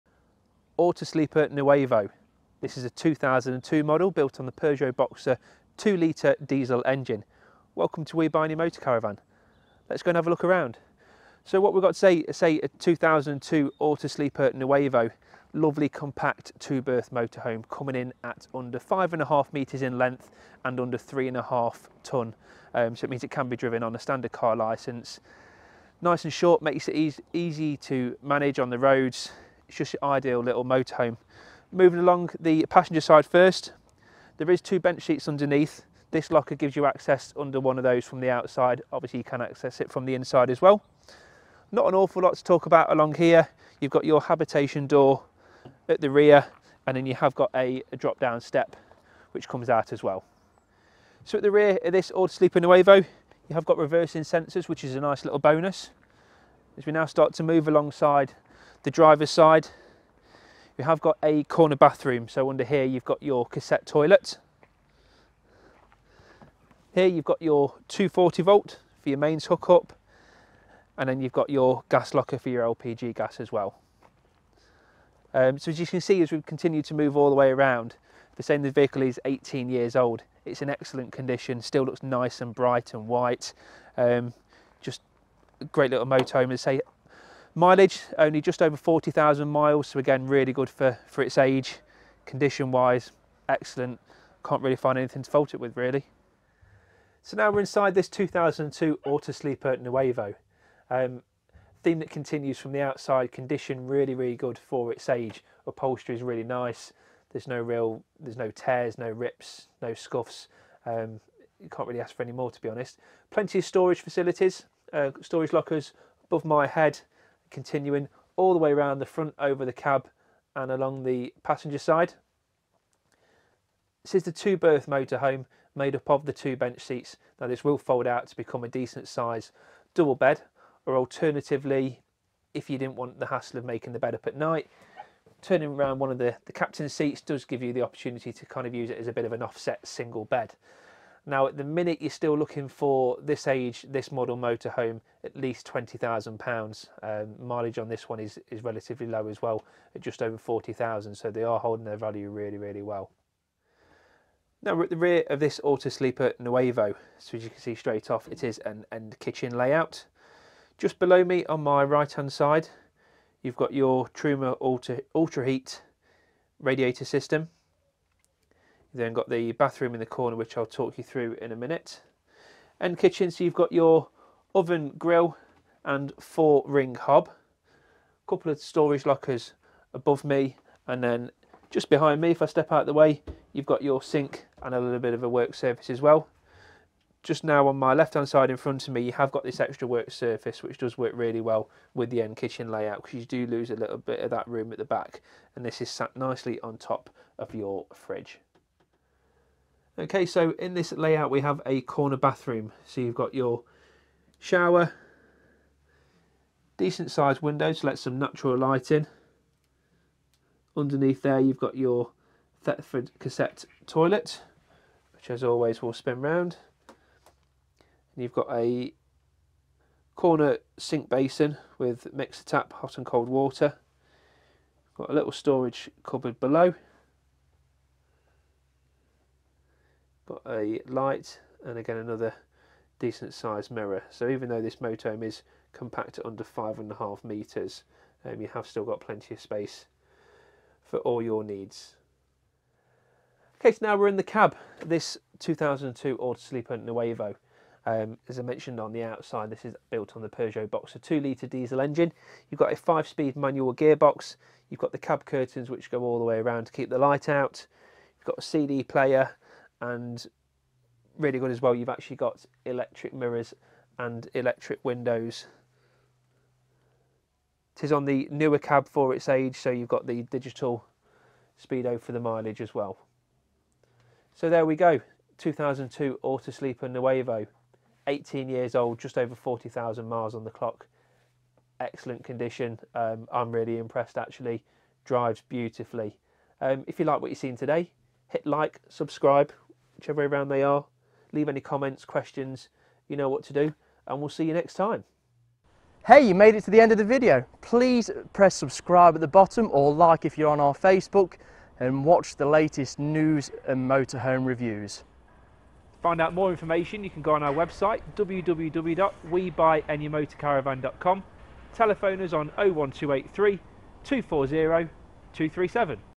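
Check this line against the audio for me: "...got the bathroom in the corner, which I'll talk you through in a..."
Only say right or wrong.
right.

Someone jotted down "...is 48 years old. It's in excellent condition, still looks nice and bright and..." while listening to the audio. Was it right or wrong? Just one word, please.
wrong.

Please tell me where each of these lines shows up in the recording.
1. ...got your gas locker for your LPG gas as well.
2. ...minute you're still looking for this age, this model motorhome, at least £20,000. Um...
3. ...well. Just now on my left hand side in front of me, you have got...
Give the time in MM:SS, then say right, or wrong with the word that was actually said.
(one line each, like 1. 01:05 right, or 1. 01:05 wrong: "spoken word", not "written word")
1. 01:11 right
2. 02:21 right
3. 03:06 right.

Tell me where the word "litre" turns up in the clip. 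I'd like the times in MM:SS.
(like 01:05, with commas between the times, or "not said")
00:05, 04:11.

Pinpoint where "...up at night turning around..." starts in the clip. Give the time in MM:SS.
02:14.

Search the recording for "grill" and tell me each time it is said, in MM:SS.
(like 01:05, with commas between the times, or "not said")
02:54.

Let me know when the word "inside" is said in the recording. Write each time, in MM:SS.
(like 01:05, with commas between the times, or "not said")
00:40, 01:37.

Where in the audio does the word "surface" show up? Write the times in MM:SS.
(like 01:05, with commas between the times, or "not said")
03:05, 03:10.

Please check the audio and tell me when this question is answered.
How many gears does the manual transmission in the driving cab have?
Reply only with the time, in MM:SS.
04:12.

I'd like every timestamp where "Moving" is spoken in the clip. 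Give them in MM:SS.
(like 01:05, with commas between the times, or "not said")
00:31.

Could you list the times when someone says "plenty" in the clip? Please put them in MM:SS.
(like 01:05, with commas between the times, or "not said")
01:53, 03:58.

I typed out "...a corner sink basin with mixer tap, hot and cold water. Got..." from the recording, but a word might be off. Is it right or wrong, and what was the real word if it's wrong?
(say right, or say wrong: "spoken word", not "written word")
right.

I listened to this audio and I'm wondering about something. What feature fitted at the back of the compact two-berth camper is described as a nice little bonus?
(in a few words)
Reversing sensors.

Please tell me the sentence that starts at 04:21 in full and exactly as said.
You've actually got electric mirrors and electric windows.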